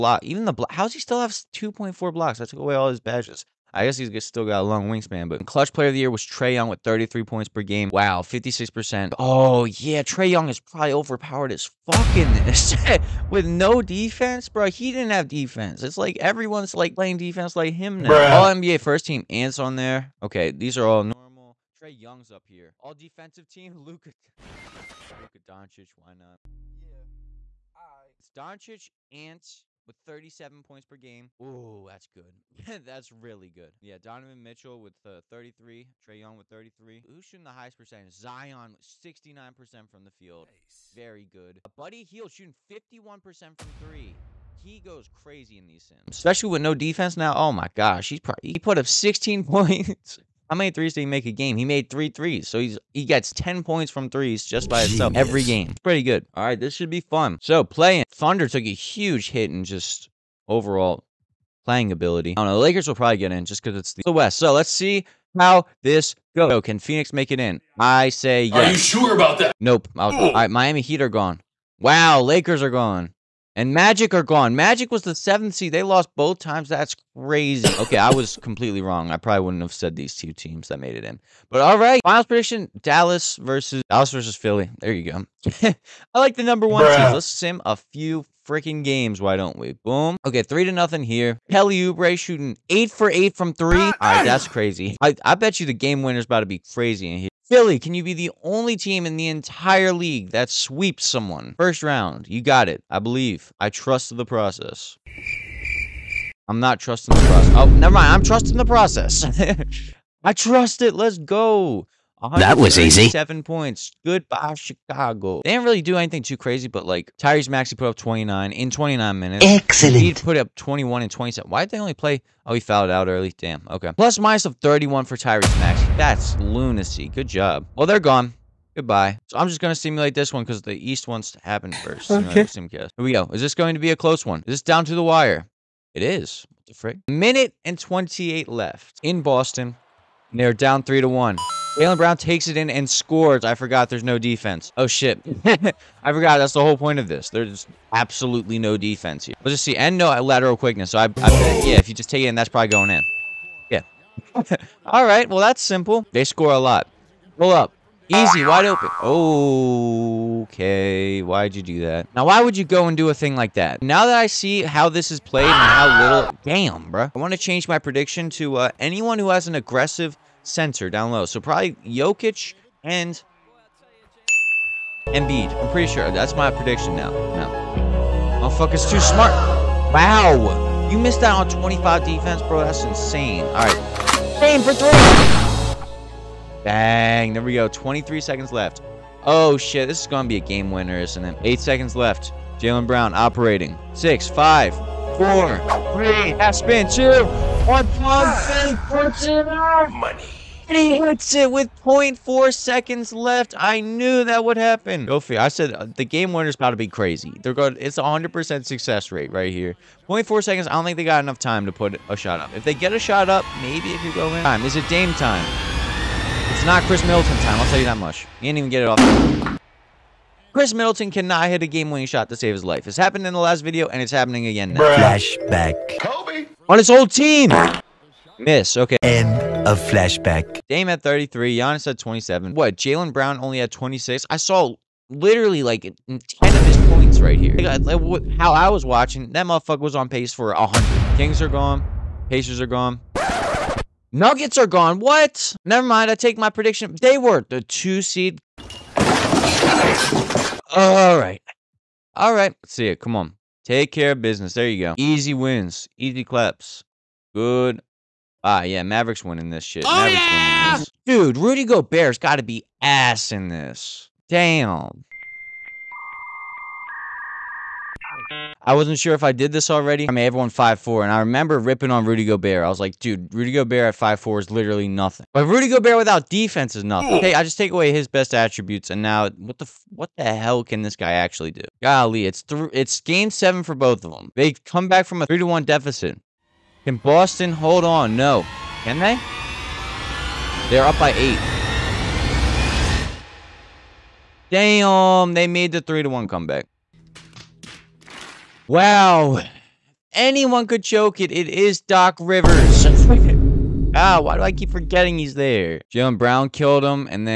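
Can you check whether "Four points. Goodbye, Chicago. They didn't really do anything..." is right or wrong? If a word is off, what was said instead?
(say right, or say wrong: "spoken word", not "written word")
wrong: "Seven", not "Four".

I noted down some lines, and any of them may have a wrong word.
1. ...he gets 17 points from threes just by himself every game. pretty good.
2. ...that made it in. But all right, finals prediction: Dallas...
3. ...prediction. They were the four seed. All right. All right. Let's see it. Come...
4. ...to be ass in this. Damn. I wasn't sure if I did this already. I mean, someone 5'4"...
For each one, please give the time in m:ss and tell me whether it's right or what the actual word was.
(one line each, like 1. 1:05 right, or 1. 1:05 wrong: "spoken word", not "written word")
1. 0:52 wrong: "10", not "17"
2. 1:20 right
3. 4:06 wrong: "two", not "four"
4. 4:22 wrong: "everyone", not "someone".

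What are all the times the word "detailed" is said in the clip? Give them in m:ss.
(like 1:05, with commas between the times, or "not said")
not said.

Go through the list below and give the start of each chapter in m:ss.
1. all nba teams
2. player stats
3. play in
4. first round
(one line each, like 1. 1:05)
1. 0:16
2. 0:27
3. 1:05
4. 1:20.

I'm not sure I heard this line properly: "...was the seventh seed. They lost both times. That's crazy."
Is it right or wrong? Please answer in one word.
right.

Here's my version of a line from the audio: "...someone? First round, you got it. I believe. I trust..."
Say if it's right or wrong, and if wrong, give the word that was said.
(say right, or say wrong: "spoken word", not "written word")
right.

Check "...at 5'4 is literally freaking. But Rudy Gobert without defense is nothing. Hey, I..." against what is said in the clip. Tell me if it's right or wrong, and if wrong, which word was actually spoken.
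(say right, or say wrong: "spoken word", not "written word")
wrong: "nothing", not "freaking".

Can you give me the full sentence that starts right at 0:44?
He goes crazy in these sims, especially with no defense now.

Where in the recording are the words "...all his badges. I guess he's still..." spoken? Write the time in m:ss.
0:02.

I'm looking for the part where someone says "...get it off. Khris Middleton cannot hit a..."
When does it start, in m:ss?
3:38.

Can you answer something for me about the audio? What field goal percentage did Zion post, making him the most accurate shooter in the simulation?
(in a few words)
69%.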